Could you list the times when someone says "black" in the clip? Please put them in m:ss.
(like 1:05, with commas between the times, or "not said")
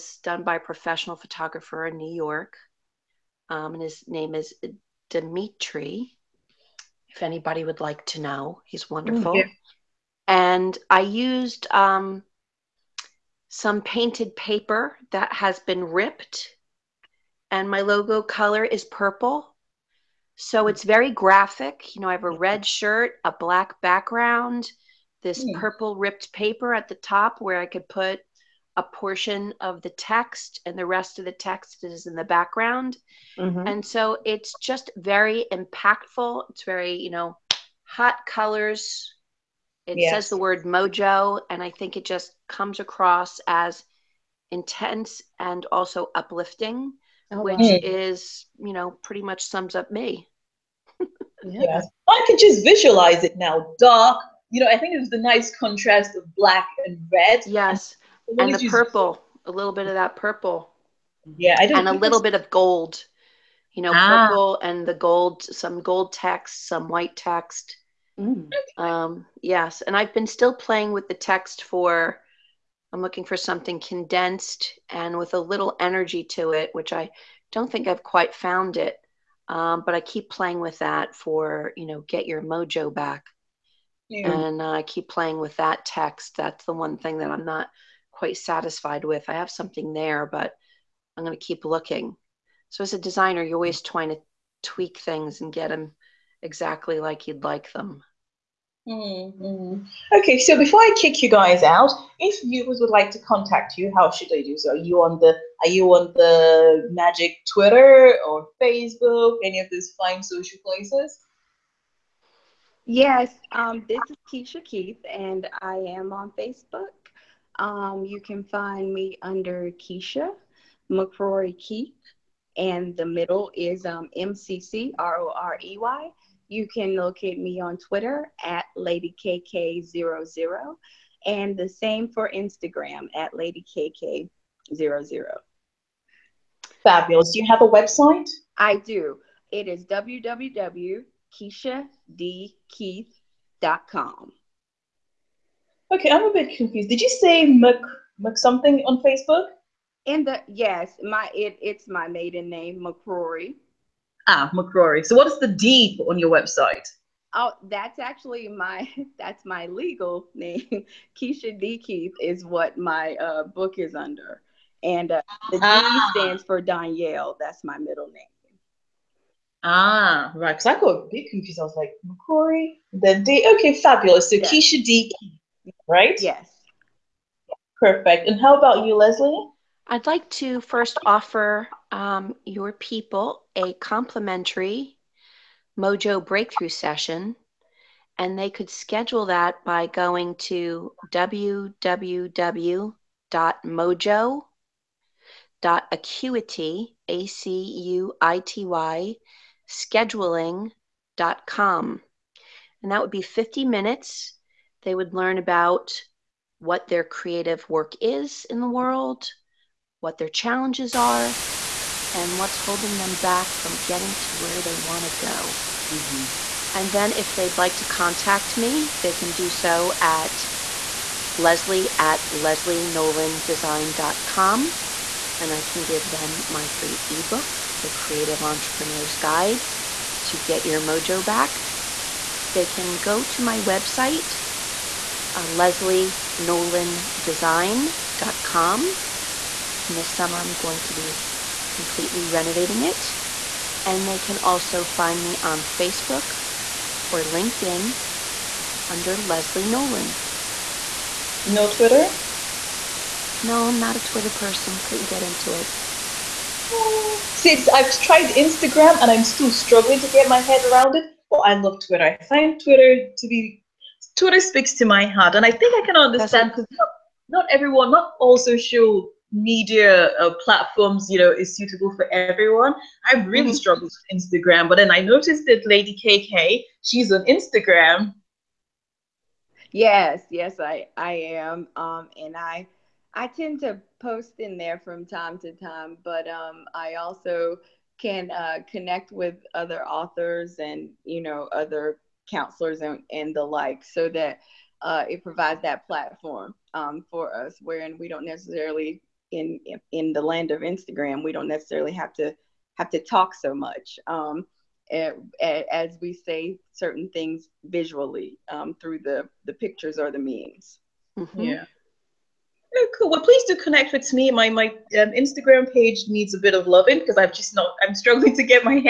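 0:23, 0:56.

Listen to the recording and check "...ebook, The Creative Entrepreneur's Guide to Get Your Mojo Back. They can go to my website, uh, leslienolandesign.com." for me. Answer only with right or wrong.
right.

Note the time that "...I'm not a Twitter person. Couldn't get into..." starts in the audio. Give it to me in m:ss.
4:13.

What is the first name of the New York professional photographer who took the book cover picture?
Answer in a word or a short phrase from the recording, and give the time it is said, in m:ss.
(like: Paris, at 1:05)
Dimitri, at 0:05.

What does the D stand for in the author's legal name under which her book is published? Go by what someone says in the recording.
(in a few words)
Danielle.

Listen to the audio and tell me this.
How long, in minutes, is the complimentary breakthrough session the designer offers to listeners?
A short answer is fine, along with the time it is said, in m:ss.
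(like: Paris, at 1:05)
50 minutes, at 3:23.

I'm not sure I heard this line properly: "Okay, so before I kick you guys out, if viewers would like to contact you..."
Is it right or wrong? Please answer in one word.
right.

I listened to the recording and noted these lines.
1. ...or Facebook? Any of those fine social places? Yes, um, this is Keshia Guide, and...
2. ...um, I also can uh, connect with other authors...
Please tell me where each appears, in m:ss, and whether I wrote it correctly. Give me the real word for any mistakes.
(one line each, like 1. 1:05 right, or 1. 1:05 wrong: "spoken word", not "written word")
1. 1:48 wrong: "Keith", not "Guide"
2. 4:46 right.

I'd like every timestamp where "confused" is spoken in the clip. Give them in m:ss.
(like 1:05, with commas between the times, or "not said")
2:26, 2:51.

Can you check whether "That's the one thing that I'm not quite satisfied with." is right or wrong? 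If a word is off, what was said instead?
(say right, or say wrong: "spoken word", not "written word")
right.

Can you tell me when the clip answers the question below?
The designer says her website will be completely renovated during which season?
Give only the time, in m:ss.
3:59.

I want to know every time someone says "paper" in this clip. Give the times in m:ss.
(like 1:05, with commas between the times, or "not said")
0:14, 0:26.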